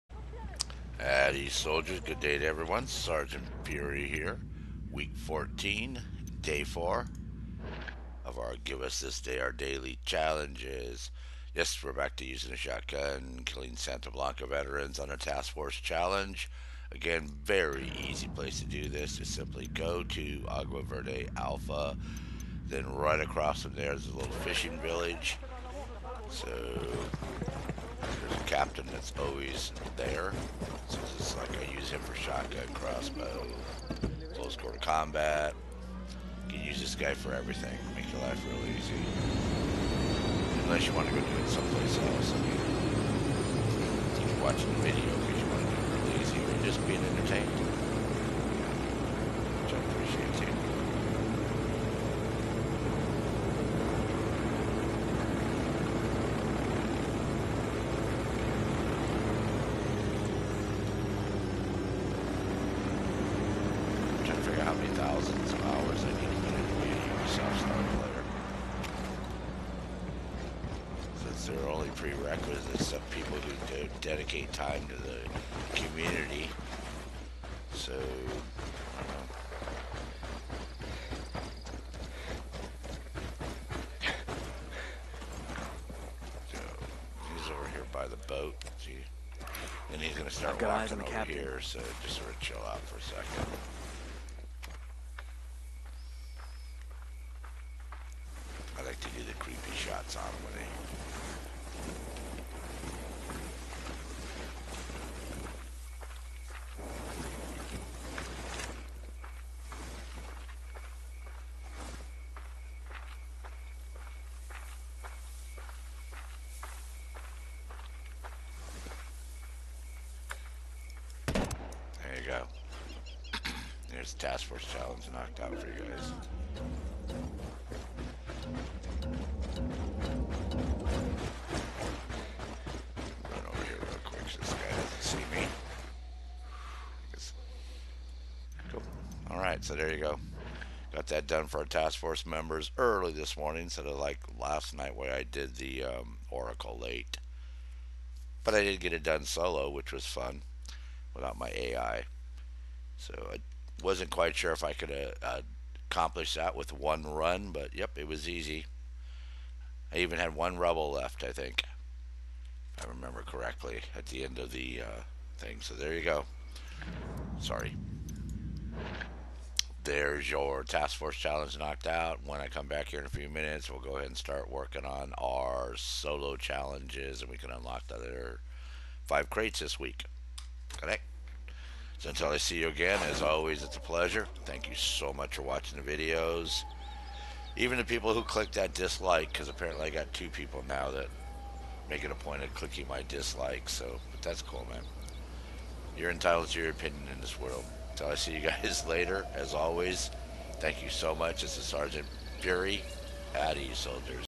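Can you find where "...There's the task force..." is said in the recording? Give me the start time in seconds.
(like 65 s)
123 s.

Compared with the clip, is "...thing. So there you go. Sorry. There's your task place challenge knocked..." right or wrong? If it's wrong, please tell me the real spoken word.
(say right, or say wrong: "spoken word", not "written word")
wrong: "force", not "place".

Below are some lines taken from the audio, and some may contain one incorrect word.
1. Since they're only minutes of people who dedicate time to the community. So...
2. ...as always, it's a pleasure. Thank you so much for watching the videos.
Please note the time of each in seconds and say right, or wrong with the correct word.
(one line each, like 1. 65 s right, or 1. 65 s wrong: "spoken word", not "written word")
1. 71 s wrong: "prerequisites", not "minutes"
2. 183 s right.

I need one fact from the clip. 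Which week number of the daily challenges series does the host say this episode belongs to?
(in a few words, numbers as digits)
14.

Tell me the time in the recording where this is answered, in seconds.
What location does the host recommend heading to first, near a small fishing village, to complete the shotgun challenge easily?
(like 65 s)
20 s.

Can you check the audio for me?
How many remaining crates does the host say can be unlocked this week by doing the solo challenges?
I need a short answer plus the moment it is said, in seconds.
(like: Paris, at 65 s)
5, at 179 s.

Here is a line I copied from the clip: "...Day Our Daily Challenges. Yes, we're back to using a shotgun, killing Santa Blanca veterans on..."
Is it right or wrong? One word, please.
right.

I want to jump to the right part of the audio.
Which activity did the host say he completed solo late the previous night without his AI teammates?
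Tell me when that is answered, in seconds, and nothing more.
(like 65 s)
146 s.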